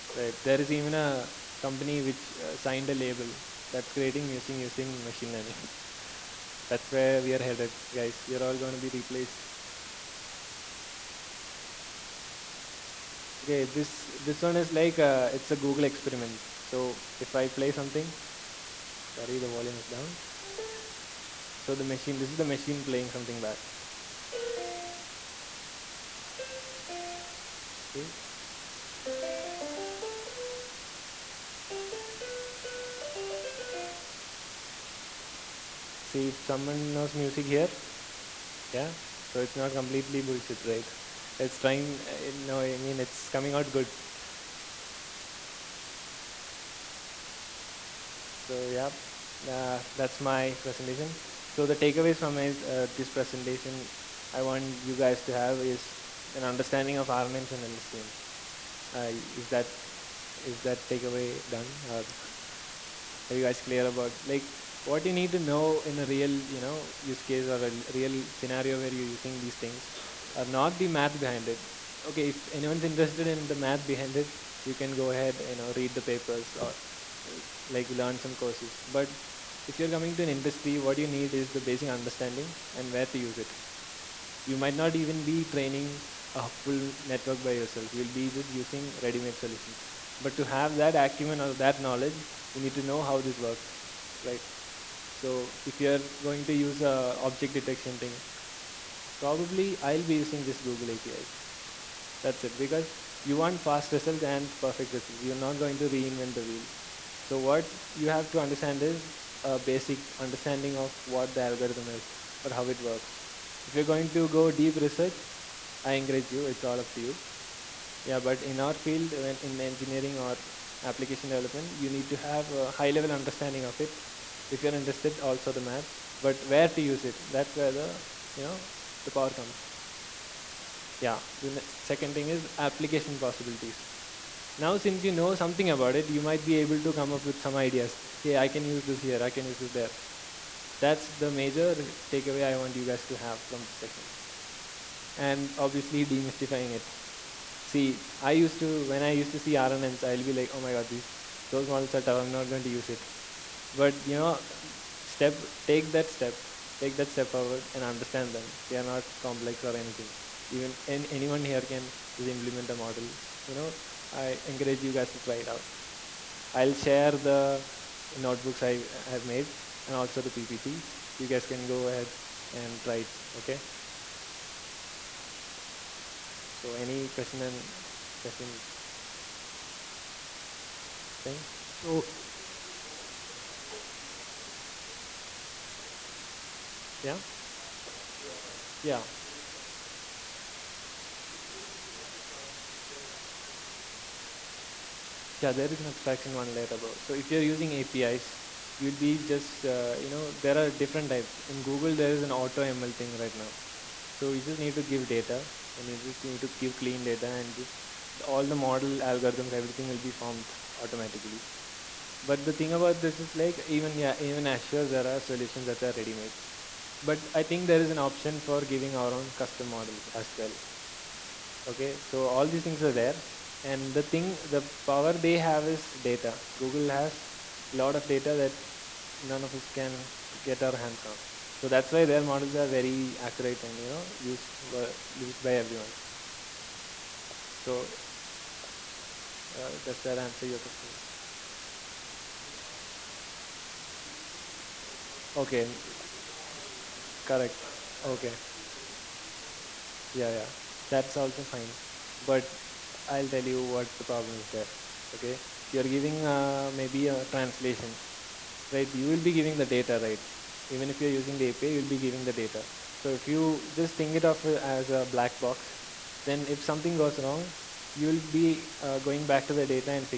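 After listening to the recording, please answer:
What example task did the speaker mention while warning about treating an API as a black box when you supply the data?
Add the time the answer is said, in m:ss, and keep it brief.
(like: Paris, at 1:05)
Translation, at 4:17.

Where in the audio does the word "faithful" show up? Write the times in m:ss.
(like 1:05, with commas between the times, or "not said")
not said.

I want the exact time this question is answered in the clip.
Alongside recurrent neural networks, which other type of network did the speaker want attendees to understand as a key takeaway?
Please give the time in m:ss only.
0:57.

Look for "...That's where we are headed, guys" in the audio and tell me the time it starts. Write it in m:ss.
0:06.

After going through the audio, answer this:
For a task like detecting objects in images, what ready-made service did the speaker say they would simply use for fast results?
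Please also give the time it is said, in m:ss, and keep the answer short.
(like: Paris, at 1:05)
Google APIs, at 1:40.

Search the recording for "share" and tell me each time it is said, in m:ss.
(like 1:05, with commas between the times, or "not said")
2:46.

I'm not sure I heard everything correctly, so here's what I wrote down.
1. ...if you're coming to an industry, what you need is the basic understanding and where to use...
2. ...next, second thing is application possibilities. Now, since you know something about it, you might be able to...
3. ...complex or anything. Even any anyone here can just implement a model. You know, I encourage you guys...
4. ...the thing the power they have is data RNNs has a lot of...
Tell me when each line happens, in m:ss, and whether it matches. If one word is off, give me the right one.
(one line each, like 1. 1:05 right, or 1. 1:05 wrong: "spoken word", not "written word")
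1. 1:19 right
2. 2:11 right
3. 2:39 right
4. 3:43 wrong: "Google", not "RNNs".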